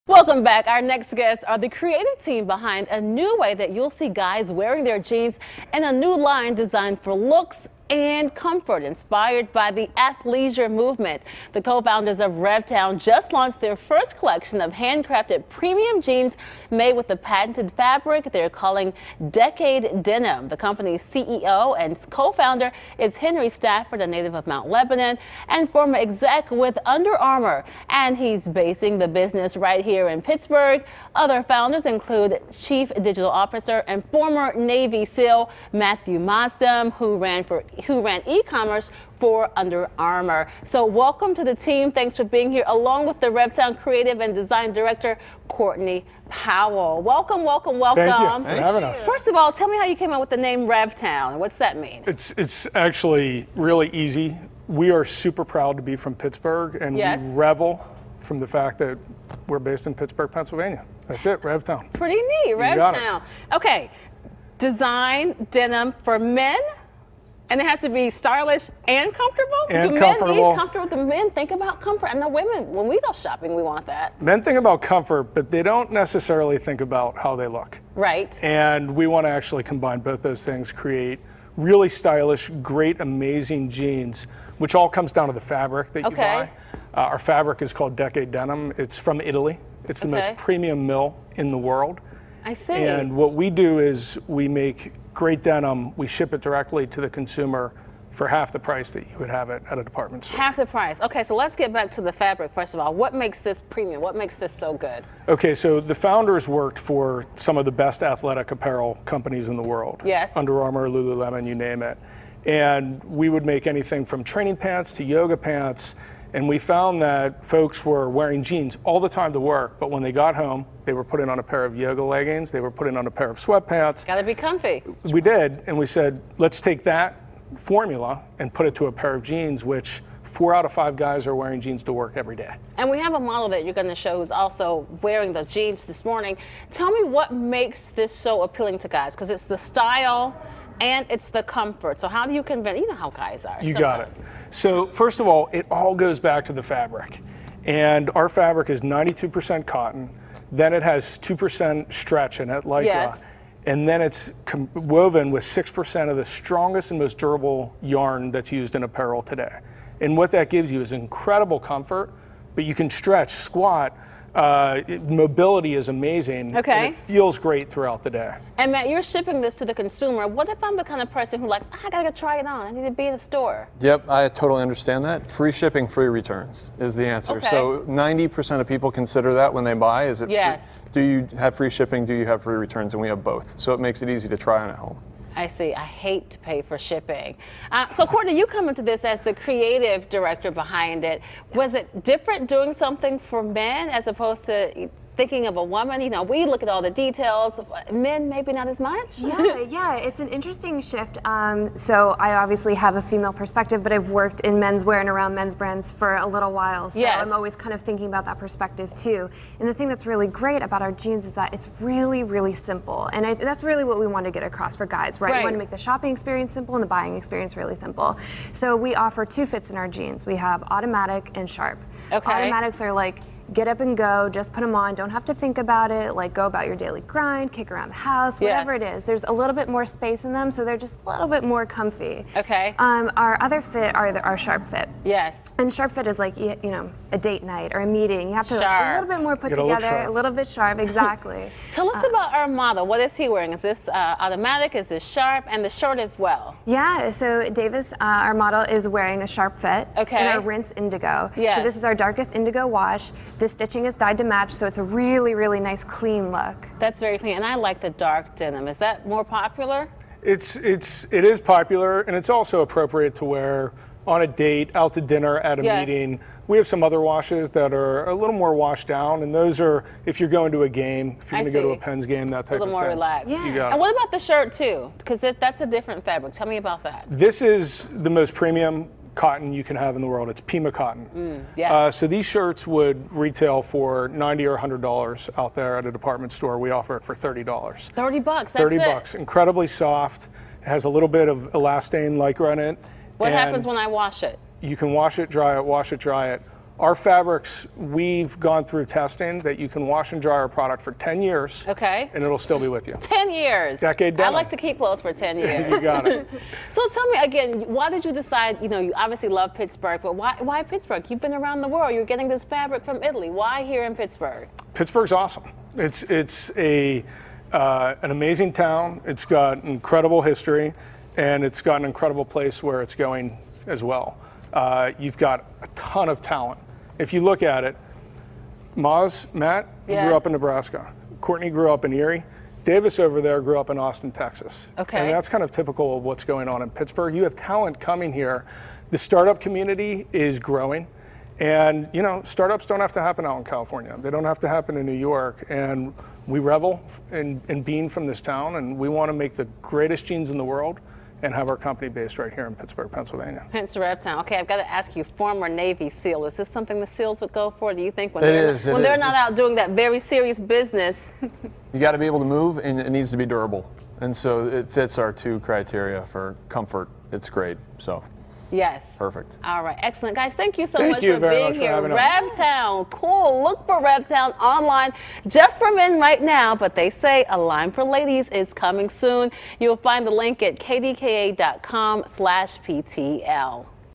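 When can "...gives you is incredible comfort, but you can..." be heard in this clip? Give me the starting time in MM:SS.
02:40.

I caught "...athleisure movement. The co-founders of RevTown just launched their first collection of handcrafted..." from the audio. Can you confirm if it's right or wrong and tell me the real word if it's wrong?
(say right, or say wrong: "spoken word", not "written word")
right.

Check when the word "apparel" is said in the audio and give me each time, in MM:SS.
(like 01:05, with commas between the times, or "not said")
01:48, 02:38.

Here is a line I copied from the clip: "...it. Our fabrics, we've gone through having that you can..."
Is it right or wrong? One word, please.
wrong.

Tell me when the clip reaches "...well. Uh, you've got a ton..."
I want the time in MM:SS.
05:23.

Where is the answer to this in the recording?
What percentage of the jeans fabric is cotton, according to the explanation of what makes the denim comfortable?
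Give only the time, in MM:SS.
02:28.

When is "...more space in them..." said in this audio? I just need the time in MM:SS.
03:49.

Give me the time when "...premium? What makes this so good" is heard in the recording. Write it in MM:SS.
01:43.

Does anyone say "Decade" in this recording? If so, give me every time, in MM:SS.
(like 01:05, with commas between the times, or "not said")
00:19, 01:27, 05:03.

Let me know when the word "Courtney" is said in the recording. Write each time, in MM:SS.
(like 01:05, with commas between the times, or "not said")
00:45, 03:08, 05:31.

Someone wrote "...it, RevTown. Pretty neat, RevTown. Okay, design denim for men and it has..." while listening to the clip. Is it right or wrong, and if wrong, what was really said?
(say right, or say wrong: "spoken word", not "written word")
right.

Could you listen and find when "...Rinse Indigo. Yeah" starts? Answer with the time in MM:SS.
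04:10.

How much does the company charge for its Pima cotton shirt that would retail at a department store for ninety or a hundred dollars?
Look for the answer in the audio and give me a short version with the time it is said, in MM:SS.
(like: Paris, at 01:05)
$30, at 04:47.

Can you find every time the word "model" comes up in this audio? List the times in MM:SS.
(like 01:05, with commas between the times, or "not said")
02:13, 04:02, 04:08.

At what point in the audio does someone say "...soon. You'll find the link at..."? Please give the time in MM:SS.
06:18.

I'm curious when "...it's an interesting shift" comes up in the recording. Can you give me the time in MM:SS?
03:19.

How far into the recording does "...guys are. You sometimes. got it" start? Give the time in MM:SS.
02:23.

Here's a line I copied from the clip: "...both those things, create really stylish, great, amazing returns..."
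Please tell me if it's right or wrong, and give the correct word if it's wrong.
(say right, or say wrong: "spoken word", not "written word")
wrong: "jeans", not "returns".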